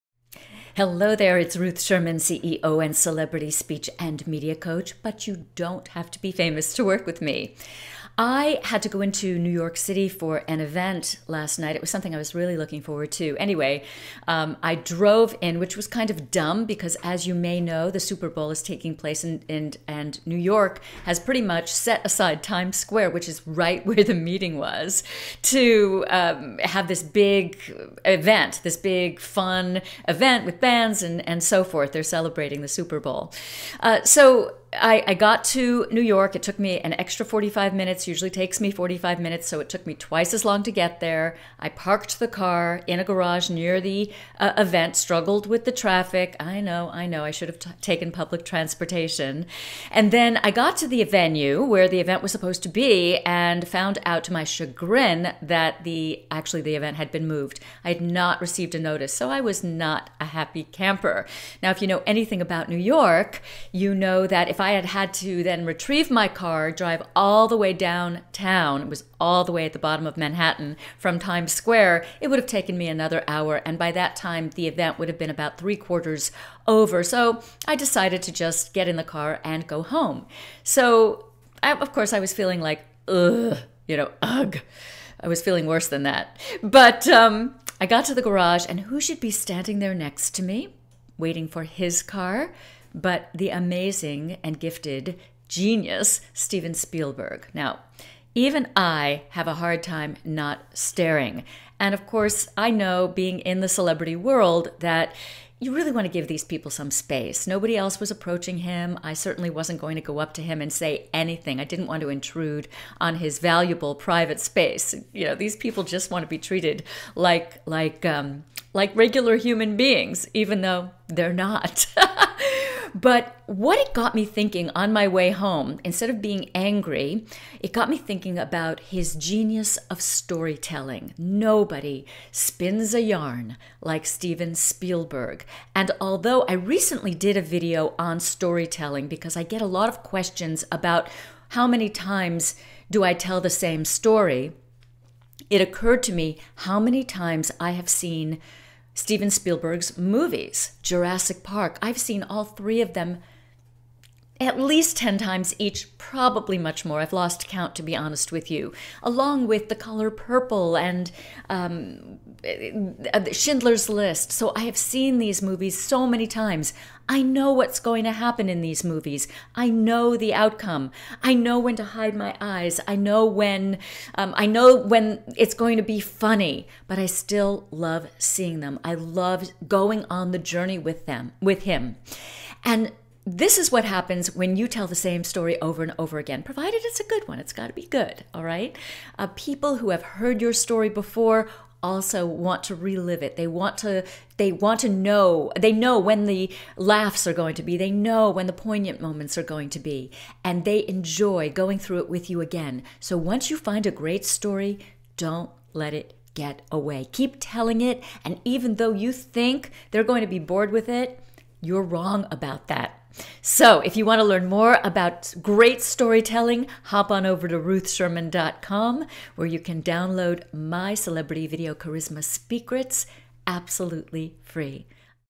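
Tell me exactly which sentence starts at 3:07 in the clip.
It's got to be good, all right?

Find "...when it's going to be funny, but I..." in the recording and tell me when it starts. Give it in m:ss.
2:54.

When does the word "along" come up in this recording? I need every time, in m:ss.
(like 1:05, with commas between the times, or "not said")
2:39.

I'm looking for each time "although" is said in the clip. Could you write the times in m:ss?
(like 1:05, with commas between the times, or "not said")
2:15.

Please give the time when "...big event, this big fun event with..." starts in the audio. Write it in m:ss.
0:27.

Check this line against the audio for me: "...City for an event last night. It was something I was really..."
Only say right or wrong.
right.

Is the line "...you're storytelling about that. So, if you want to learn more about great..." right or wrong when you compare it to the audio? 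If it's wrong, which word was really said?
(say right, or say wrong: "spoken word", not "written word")
wrong: "wrong", not "storytelling".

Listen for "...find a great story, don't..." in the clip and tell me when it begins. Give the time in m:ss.
3:23.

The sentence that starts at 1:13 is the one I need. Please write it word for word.
And by that time, the event would have been about three quarters over.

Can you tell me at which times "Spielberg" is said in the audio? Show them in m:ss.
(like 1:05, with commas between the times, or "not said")
1:36, 2:14, 2:29.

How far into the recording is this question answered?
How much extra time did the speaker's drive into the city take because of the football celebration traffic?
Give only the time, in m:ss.
0:36.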